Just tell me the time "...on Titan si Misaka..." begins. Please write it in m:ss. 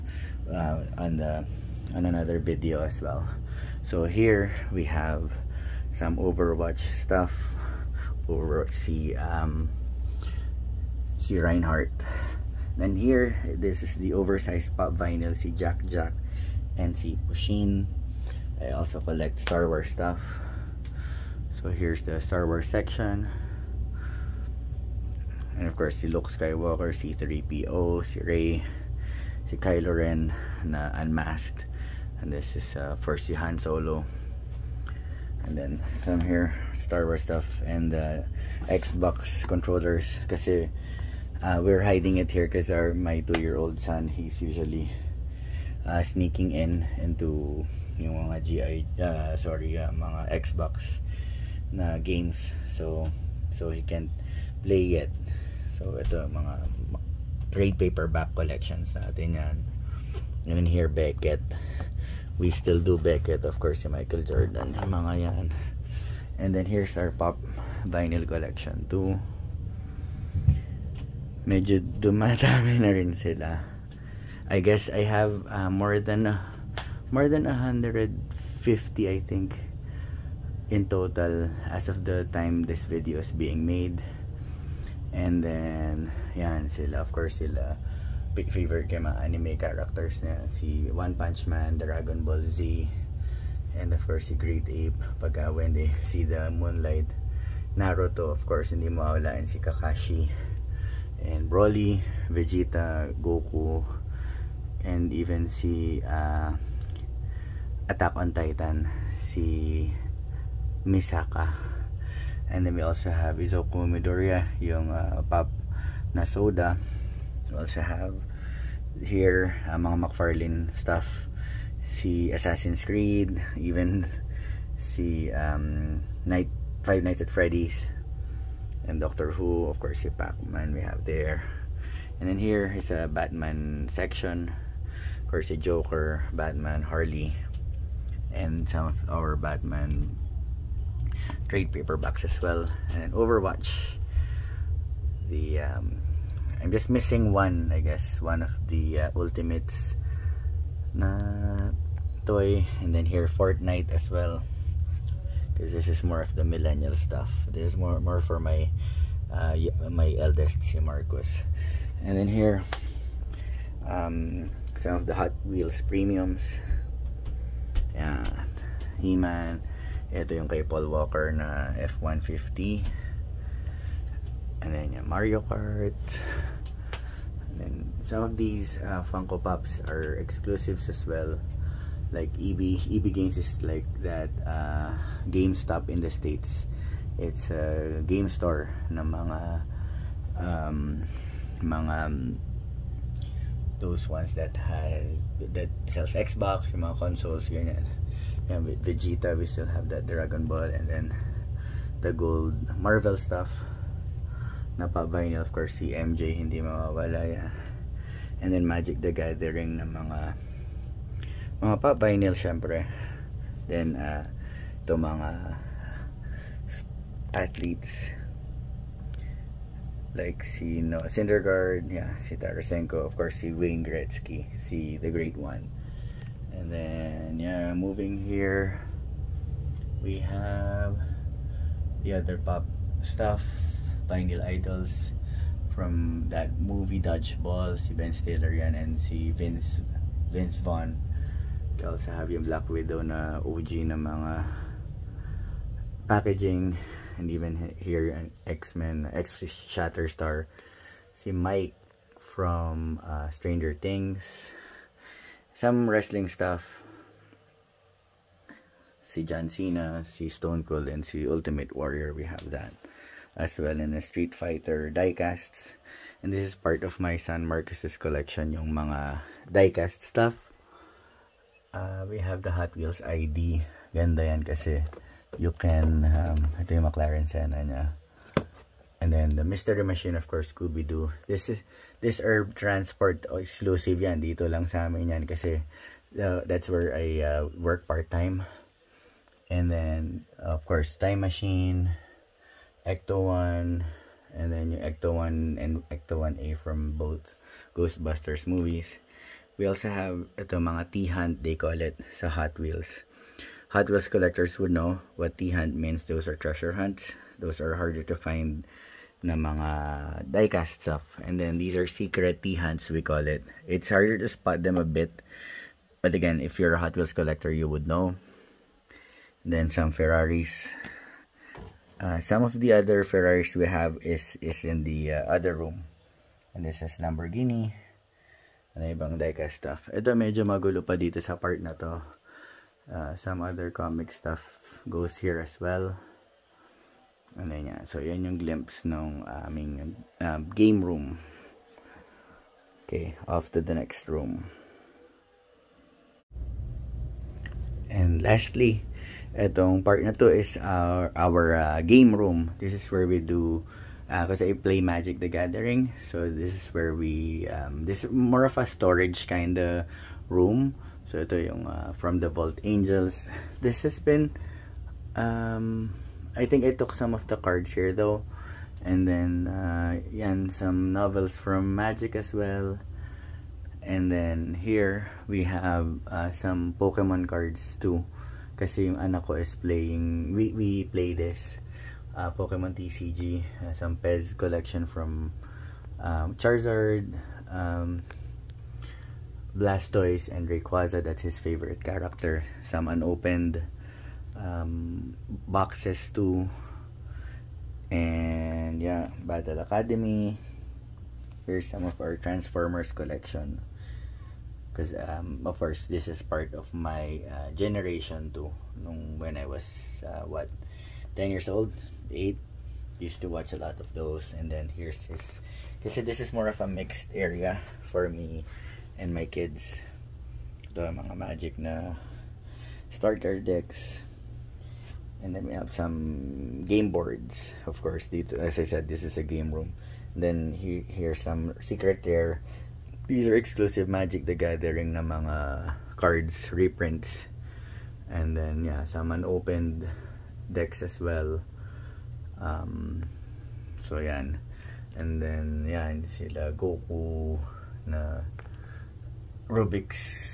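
1:48.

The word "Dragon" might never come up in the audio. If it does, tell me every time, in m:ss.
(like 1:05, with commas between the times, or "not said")
1:31, 3:20.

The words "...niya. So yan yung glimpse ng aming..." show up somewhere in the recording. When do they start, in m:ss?
5:37.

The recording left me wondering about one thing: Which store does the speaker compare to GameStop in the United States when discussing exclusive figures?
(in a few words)
EB Games.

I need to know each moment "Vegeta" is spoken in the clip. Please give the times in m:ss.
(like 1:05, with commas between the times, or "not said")
1:42, 3:18.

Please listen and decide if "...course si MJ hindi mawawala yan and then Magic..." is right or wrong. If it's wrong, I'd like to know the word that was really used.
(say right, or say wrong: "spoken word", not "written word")
right.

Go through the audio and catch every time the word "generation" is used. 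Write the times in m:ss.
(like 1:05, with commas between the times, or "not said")
6:47.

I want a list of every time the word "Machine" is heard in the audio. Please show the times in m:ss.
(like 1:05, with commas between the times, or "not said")
4:39, 4:51.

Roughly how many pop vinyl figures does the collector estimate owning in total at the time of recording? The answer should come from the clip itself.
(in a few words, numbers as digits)
more than 150.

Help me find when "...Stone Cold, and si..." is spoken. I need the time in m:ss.
4:20.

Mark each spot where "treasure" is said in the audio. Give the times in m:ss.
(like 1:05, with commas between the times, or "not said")
5:06.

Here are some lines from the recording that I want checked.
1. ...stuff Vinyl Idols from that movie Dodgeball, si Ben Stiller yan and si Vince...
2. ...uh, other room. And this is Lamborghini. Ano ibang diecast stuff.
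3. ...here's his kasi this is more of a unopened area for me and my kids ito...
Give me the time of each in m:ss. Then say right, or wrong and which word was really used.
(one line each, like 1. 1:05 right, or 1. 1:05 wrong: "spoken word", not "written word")
1. 3:53 right
2. 5:25 right
3. 6:54 wrong: "mixed", not "unopened".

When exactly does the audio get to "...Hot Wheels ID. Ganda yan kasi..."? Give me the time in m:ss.
4:32.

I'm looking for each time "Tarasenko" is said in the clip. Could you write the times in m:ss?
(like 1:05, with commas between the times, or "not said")
3:42.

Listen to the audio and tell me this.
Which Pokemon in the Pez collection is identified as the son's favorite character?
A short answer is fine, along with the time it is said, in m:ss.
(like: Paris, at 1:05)
Rayquaza, at 6:30.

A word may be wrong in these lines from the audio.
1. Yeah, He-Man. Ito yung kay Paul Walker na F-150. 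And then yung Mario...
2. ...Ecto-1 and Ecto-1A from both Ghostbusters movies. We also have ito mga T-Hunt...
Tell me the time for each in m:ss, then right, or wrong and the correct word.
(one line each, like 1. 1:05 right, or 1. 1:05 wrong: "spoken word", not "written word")
1. 2:47 right
2. 4:54 right.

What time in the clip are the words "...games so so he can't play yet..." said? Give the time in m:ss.
0:51.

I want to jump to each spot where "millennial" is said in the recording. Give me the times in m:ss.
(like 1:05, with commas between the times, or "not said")
2:36.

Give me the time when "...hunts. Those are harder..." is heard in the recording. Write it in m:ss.
5:06.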